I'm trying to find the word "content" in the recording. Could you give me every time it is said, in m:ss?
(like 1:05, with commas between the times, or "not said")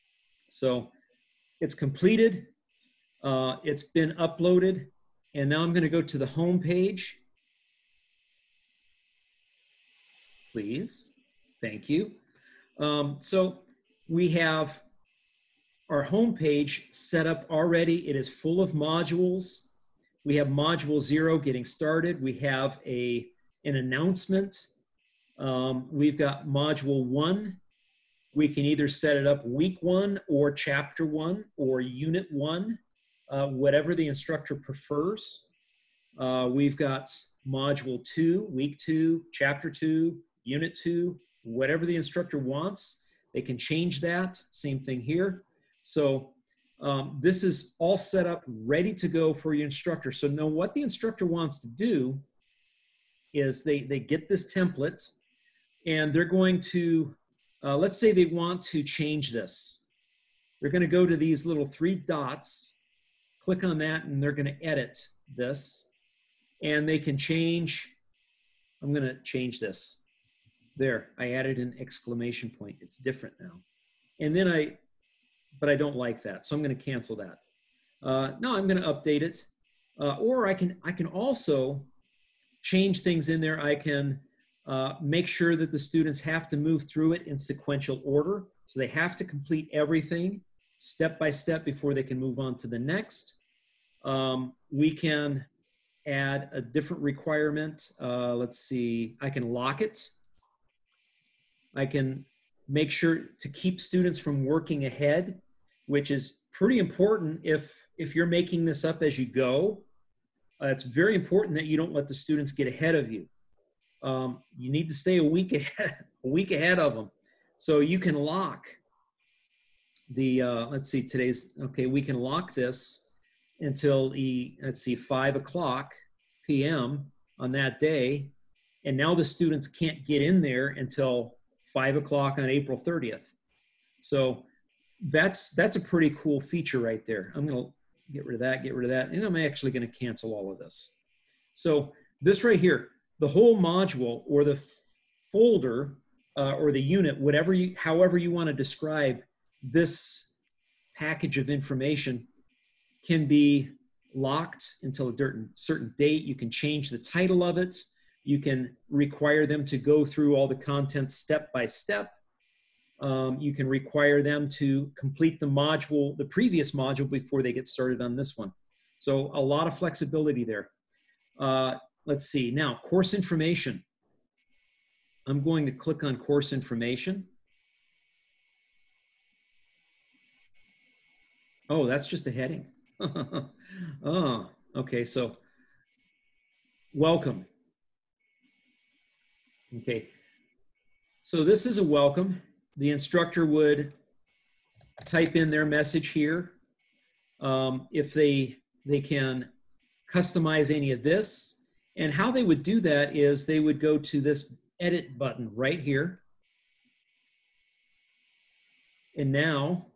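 2:40.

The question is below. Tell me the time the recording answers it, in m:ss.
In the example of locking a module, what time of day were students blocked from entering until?
2:04.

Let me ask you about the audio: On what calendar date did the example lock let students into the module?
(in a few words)
April 30th.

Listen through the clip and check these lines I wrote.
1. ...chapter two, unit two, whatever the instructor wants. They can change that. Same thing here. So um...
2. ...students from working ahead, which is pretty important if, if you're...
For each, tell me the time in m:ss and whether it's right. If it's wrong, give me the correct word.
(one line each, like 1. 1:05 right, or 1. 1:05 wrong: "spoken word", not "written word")
1. 0:39 right
2. 1:43 right.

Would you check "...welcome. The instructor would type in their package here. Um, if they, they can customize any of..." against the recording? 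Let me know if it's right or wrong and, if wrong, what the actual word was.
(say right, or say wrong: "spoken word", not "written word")
wrong: "message", not "package".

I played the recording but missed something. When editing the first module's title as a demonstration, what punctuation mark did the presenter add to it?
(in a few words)
exclamation point.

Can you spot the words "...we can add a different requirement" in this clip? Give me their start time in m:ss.
1:34.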